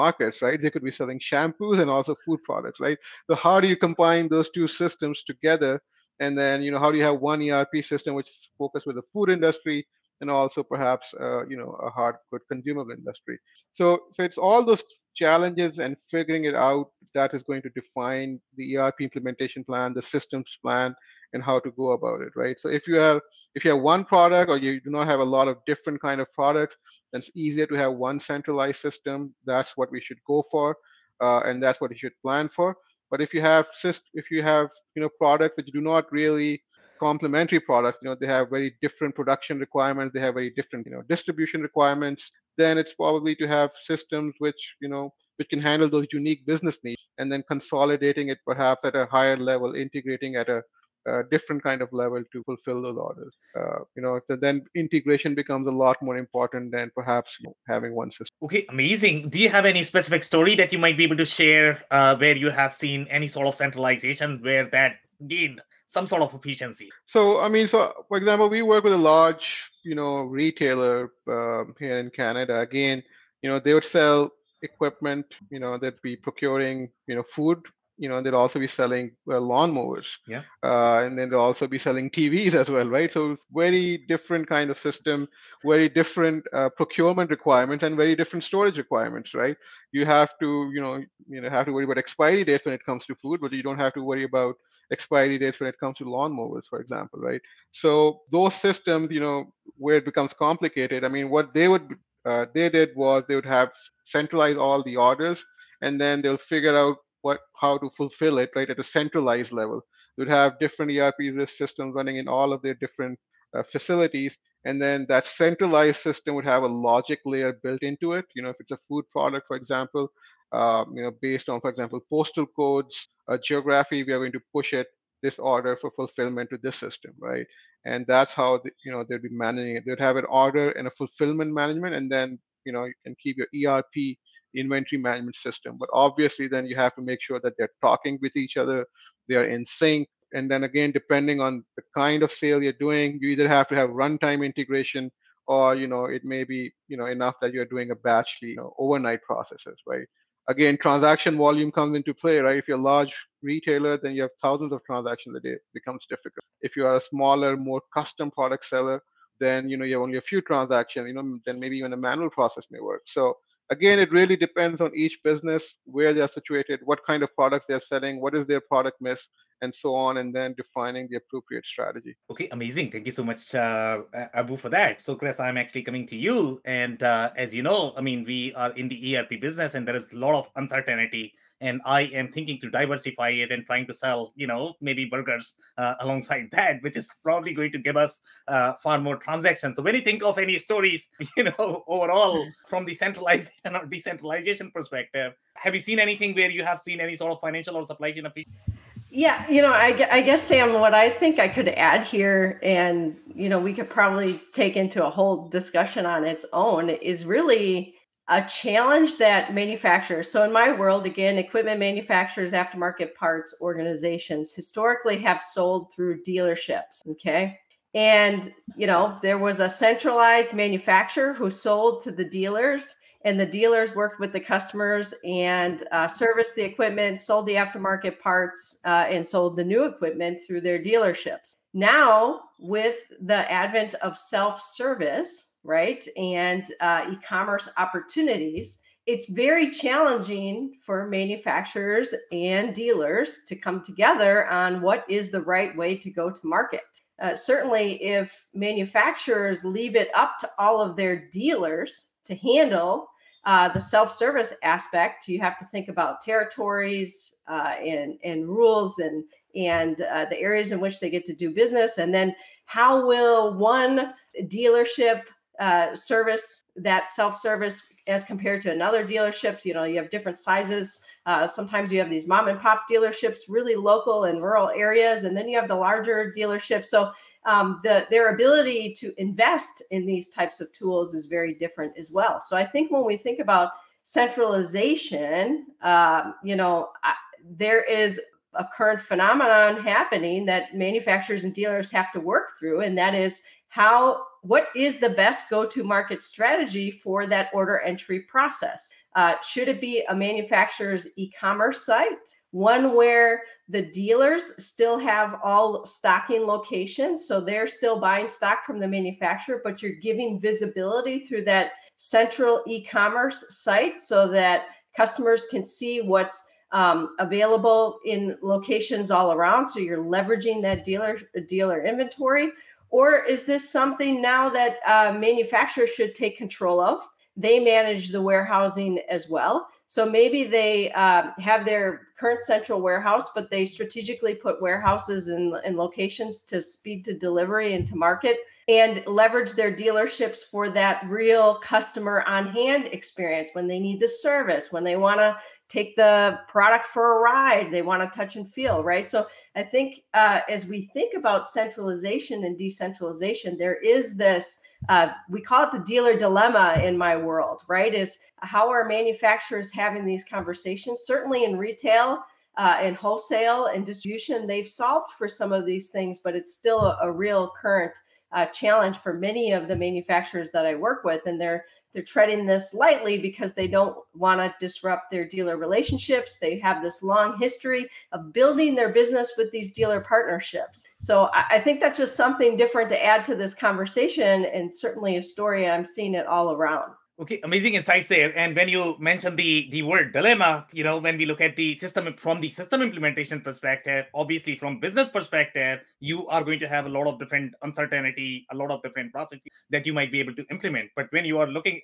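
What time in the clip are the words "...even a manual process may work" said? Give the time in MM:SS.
02:41.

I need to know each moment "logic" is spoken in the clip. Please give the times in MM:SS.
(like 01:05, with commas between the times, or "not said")
01:56.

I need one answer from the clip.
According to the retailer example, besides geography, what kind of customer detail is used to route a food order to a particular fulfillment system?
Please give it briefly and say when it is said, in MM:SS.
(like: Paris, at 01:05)
postal codes, at 02:02.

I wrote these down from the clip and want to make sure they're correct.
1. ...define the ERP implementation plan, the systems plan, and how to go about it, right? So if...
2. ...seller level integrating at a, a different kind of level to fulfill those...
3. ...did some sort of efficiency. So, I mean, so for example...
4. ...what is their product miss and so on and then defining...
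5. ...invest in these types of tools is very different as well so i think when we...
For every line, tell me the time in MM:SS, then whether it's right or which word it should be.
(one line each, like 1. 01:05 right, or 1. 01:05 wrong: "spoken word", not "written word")
1. 00:17 right
2. 00:49 wrong: "higher", not "seller"
3. 01:05 right
4. 02:48 right
5. 04:39 right.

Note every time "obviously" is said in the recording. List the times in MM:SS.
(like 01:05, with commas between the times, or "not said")
02:15, 06:34.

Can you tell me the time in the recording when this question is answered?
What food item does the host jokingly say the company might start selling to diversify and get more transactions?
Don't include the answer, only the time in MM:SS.
03:05.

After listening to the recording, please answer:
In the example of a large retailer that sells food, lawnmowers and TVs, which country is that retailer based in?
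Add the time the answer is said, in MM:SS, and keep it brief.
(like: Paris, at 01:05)
Canada, at 01:12.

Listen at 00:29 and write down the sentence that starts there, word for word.
That's what we should go for, uh, and that's what you should plan for.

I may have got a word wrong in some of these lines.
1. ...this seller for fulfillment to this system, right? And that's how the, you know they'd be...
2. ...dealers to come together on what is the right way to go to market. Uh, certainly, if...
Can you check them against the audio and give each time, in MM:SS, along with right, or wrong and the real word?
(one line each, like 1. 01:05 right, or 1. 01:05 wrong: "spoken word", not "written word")
1. 02:05 wrong: "order", not "seller"
2. 04:02 right.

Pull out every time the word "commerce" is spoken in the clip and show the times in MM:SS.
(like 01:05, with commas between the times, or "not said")
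03:57, 05:01, 05:12.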